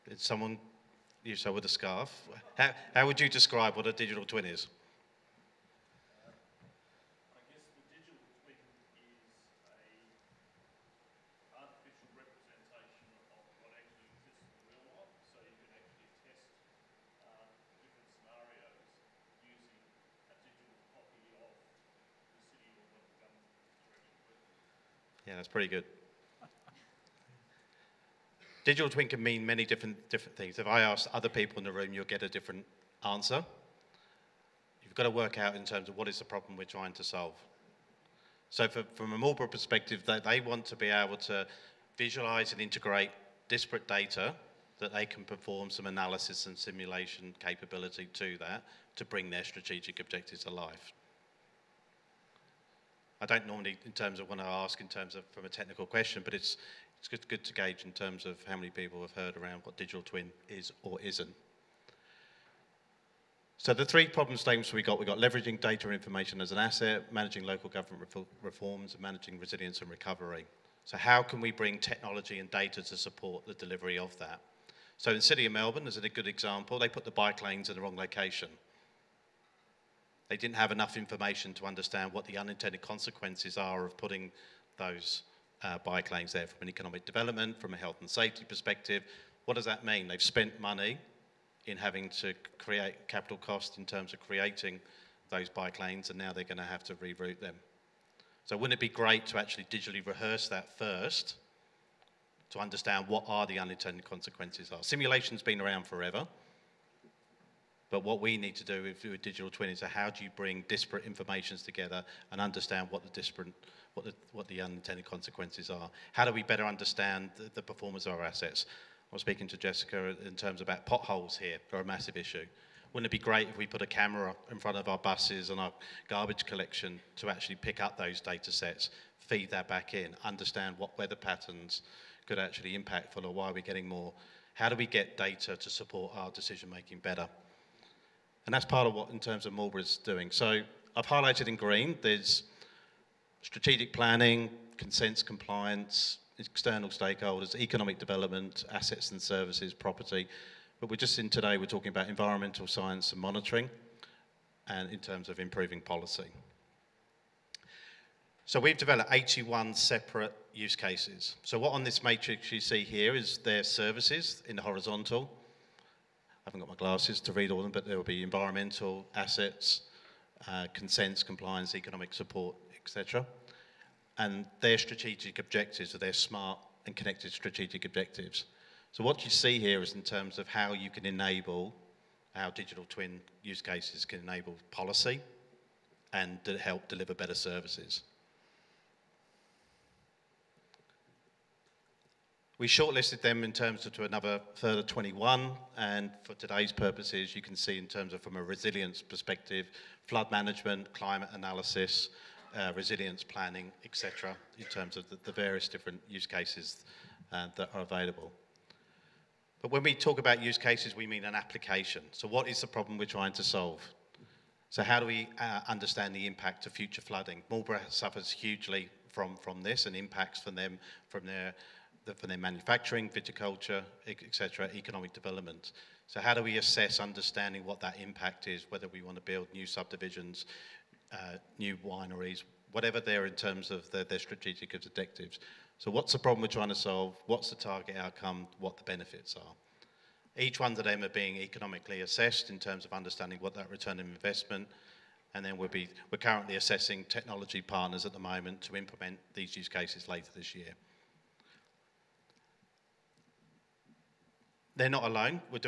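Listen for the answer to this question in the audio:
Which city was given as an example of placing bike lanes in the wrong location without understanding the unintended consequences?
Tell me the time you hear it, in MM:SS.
01:15.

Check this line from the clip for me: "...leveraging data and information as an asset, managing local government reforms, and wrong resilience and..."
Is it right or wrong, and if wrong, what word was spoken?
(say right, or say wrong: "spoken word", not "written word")
wrong: "managing", not "wrong".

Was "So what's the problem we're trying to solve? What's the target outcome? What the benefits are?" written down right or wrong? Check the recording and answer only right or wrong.
right.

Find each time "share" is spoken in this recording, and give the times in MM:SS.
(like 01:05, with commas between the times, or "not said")
not said.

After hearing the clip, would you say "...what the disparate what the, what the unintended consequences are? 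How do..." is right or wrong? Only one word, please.
right.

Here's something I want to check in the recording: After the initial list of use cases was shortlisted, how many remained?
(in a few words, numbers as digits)
21.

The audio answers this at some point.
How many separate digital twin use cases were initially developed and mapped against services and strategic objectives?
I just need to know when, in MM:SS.
02:39.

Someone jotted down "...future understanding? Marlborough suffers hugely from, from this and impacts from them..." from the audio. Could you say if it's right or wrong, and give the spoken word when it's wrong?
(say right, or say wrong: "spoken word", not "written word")
wrong: "flooding", not "understanding".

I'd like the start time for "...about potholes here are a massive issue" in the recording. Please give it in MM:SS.
02:00.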